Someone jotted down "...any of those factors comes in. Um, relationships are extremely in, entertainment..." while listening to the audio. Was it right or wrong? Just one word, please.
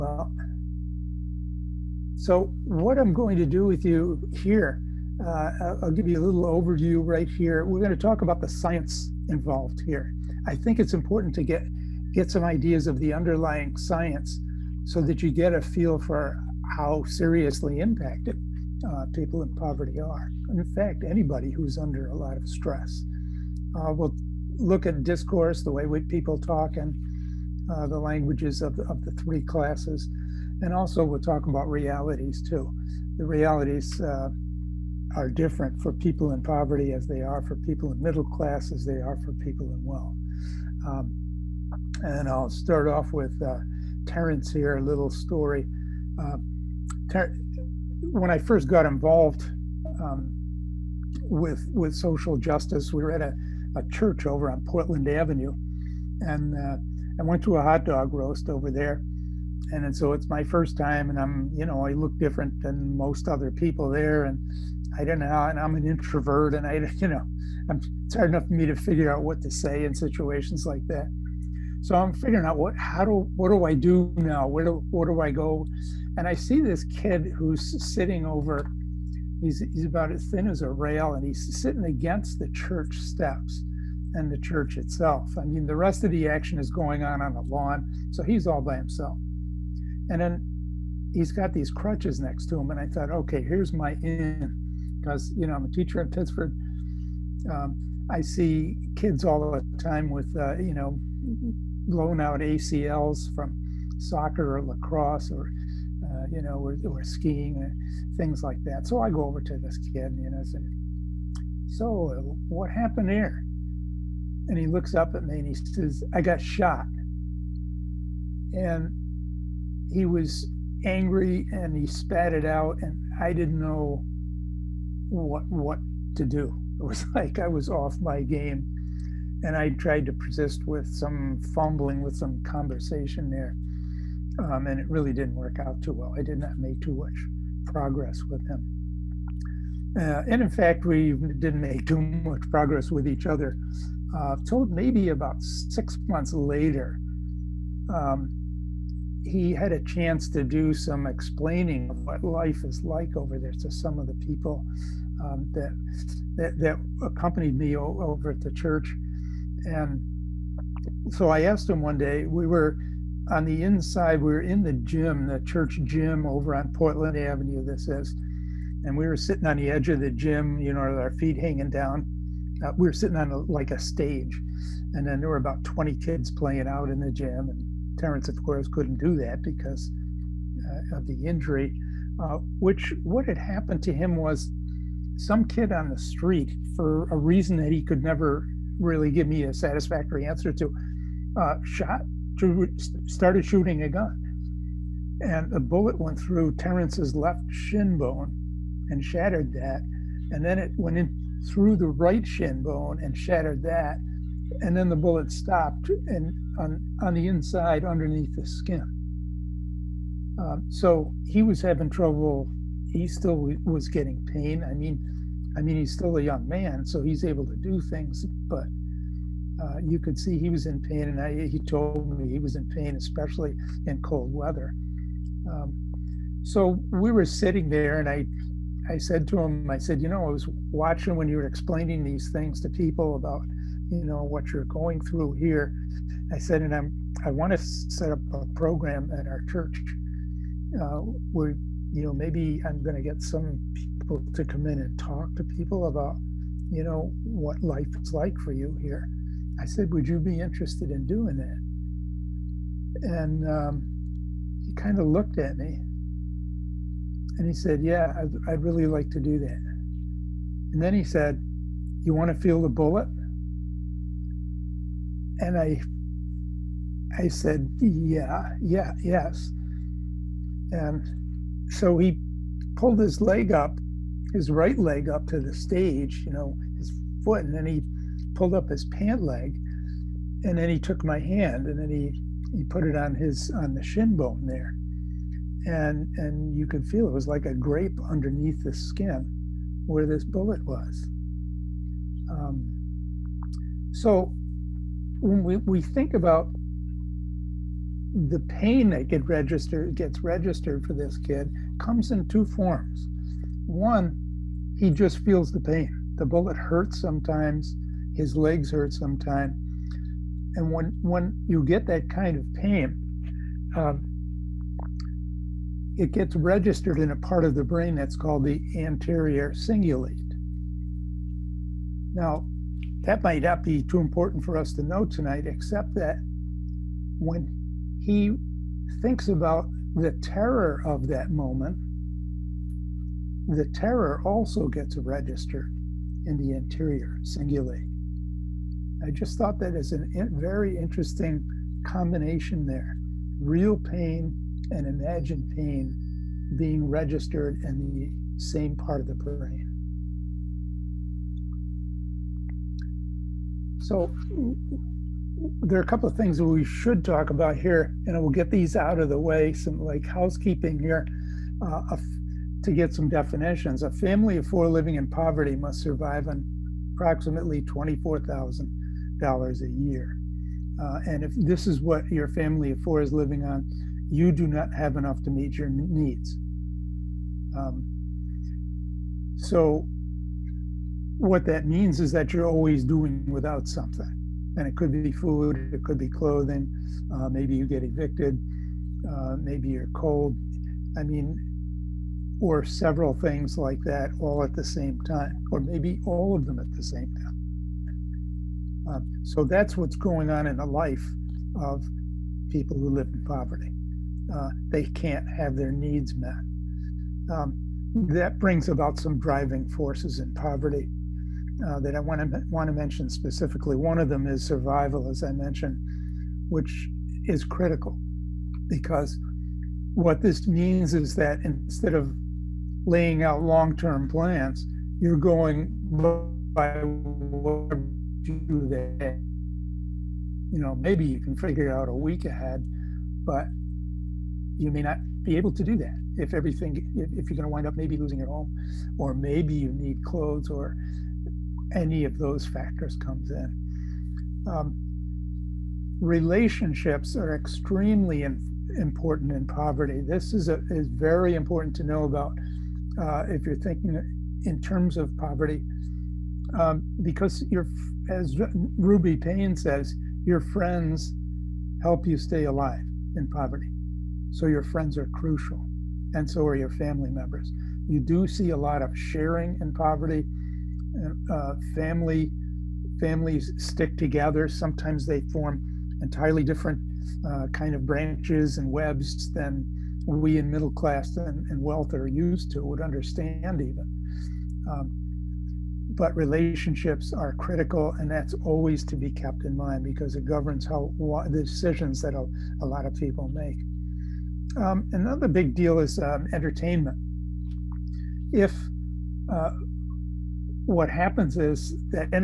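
wrong.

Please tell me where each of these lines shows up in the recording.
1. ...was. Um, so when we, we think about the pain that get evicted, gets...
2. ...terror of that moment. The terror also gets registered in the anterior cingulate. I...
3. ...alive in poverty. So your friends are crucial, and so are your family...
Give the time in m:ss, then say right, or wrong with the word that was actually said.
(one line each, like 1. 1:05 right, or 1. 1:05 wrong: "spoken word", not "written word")
1. 4:50 wrong: "registered", not "evicted"
2. 5:30 right
3. 7:42 right.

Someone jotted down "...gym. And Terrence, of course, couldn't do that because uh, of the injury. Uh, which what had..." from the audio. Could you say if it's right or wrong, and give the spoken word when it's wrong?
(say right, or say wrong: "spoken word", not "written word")
right.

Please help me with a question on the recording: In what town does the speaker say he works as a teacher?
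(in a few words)
Pittsford.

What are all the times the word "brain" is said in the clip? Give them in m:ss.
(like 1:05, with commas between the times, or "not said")
5:17, 5:49.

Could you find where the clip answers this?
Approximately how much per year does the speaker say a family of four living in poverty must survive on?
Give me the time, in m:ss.
6:07.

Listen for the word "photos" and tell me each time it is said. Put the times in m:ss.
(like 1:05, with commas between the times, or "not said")
not said.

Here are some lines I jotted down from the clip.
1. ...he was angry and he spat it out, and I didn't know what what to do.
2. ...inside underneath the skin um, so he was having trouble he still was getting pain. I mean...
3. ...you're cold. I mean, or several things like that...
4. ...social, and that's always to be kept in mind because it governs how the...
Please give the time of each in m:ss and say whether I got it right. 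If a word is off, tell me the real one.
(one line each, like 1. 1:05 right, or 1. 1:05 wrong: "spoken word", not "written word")
1. 1:59 right
2. 3:27 right
3. 6:29 right
4. 8:07 wrong: "critical", not "social".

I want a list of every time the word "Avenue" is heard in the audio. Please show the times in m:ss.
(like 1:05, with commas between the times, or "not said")
0:55, 2:47.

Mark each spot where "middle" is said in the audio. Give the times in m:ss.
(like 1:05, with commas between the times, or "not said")
0:38, 8:00.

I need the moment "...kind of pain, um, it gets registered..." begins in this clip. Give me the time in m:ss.
5:12.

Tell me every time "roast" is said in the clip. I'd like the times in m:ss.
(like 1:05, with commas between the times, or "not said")
0:58.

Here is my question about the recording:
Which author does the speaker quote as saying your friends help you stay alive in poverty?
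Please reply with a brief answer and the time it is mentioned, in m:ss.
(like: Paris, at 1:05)
Ruby Payne, at 7:38.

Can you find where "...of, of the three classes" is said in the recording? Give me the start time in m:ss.
0:28.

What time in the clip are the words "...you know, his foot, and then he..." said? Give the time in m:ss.
4:36.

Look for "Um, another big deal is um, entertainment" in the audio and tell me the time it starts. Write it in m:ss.
8:14.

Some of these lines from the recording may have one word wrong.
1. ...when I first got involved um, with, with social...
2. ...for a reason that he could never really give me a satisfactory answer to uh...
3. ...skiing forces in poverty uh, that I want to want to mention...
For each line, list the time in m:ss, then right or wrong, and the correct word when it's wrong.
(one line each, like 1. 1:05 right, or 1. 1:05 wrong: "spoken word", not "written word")
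1. 0:48 right
2. 3:06 right
3. 6:49 wrong: "driving", not "skiing".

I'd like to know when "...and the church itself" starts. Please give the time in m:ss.
1:24.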